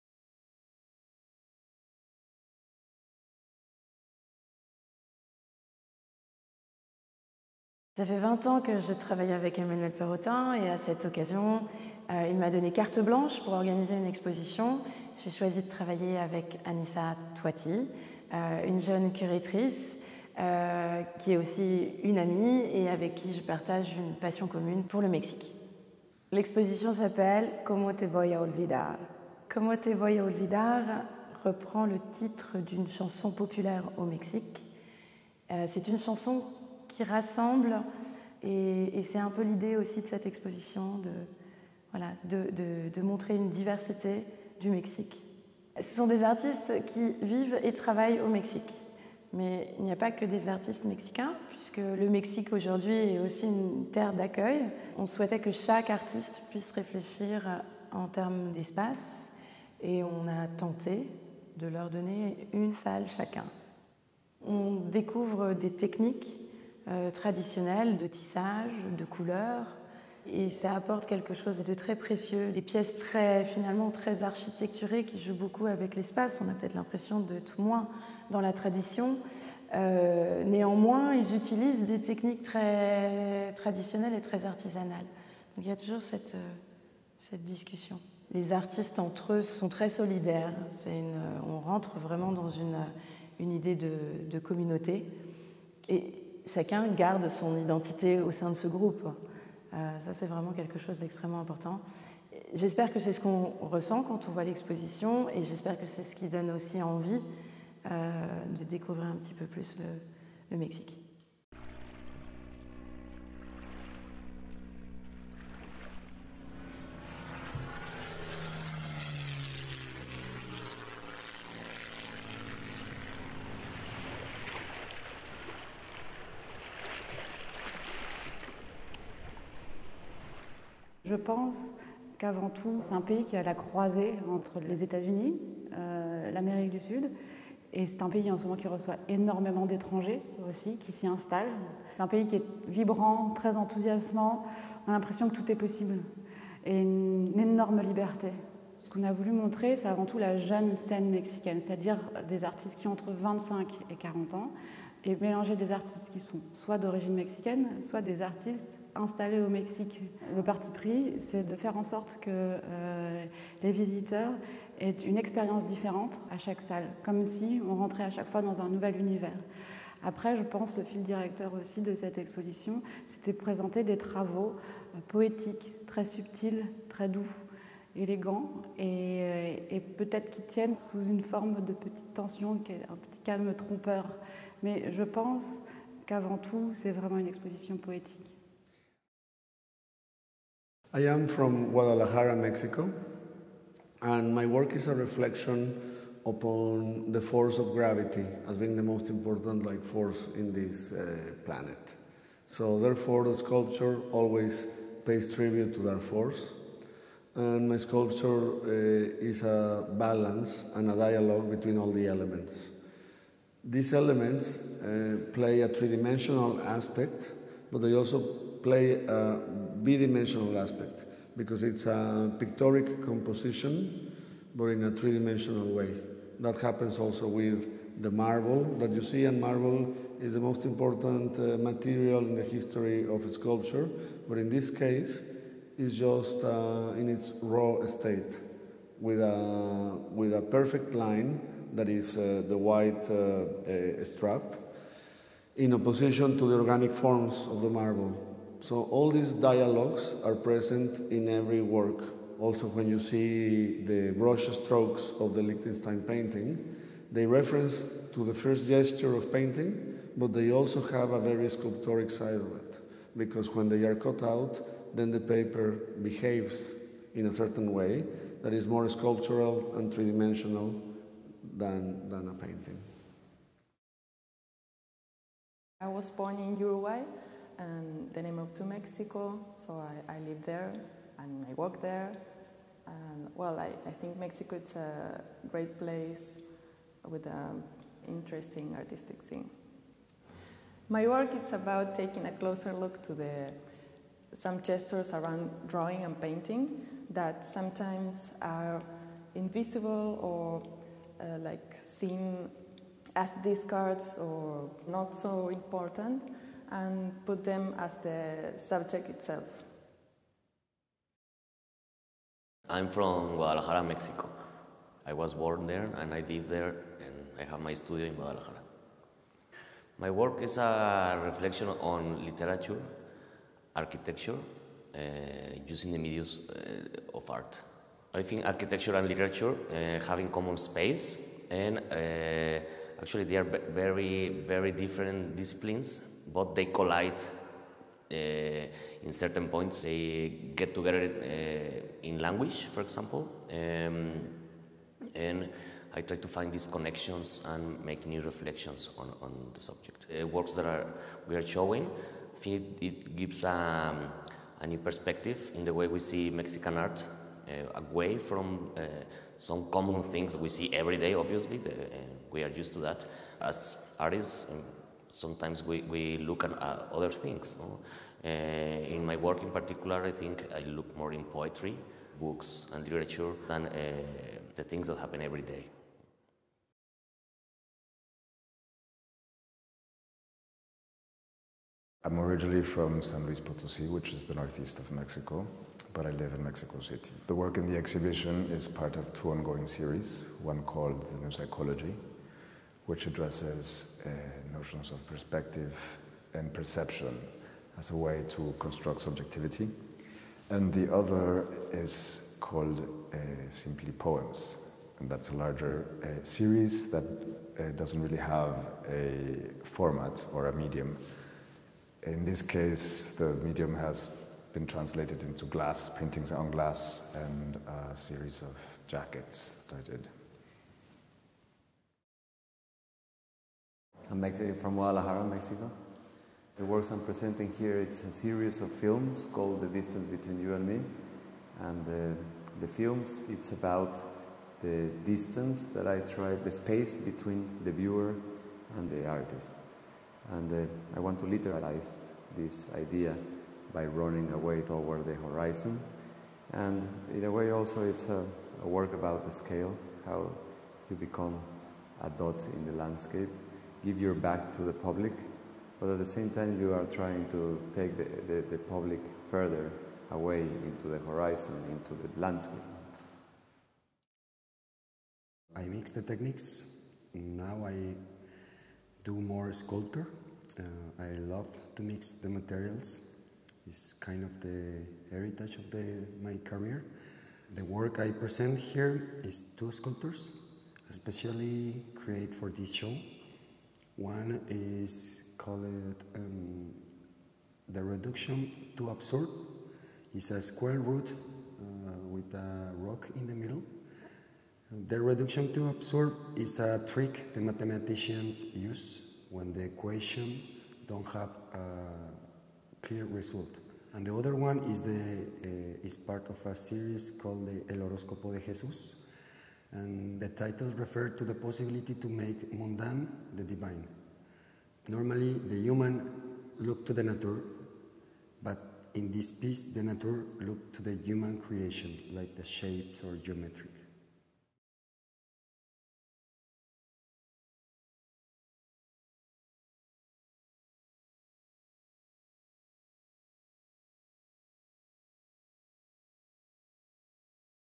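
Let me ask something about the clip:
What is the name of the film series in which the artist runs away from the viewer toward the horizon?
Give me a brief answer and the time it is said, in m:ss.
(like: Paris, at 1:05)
The Distance Between You and Me, at 7:09.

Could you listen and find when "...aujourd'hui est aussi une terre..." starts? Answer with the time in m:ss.
0:52.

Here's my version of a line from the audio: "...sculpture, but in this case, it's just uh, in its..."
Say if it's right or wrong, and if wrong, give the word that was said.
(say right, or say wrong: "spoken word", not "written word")
right.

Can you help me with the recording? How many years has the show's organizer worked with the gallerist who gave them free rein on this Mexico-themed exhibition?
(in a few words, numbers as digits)
20.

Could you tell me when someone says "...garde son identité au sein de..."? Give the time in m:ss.
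1:36.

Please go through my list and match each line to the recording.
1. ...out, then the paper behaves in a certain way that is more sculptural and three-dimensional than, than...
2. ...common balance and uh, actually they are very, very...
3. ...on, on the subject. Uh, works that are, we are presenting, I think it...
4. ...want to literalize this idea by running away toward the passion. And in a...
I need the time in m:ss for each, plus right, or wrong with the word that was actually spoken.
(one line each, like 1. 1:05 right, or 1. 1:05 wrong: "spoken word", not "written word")
1. 4:24 right
2. 5:30 wrong: "space", not "balance"
3. 5:48 wrong: "showing", not "presenting"
4. 7:20 wrong: "horizon", not "passion".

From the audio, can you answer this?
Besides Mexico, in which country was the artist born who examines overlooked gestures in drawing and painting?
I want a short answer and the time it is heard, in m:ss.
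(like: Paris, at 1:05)
Uruguay, at 4:36.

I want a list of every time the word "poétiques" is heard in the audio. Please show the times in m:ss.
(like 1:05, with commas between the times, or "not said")
2:55, 3:07.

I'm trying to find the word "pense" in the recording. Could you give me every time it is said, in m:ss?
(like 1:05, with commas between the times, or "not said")
2:11, 2:50, 3:05.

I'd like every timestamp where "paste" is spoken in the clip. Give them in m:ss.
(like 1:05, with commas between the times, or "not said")
not said.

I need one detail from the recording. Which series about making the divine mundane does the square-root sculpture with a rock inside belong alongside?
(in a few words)
El Horóscopo de Jesús.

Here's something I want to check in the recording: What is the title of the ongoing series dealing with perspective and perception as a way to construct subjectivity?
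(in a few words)
The New Psychology.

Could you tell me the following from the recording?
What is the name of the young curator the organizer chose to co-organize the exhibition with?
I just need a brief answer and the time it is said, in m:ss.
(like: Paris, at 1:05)
Anissa Toiti, at 0:16.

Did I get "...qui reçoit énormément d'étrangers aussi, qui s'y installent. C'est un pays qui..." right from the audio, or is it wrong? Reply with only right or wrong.
right.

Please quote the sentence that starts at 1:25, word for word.
Donc il y a toujours cette, euh, cette discussion.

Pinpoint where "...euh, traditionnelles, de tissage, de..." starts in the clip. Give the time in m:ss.
1:06.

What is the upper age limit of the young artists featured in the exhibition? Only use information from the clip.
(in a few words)
40.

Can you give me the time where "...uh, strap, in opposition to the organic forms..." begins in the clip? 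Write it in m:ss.
4:03.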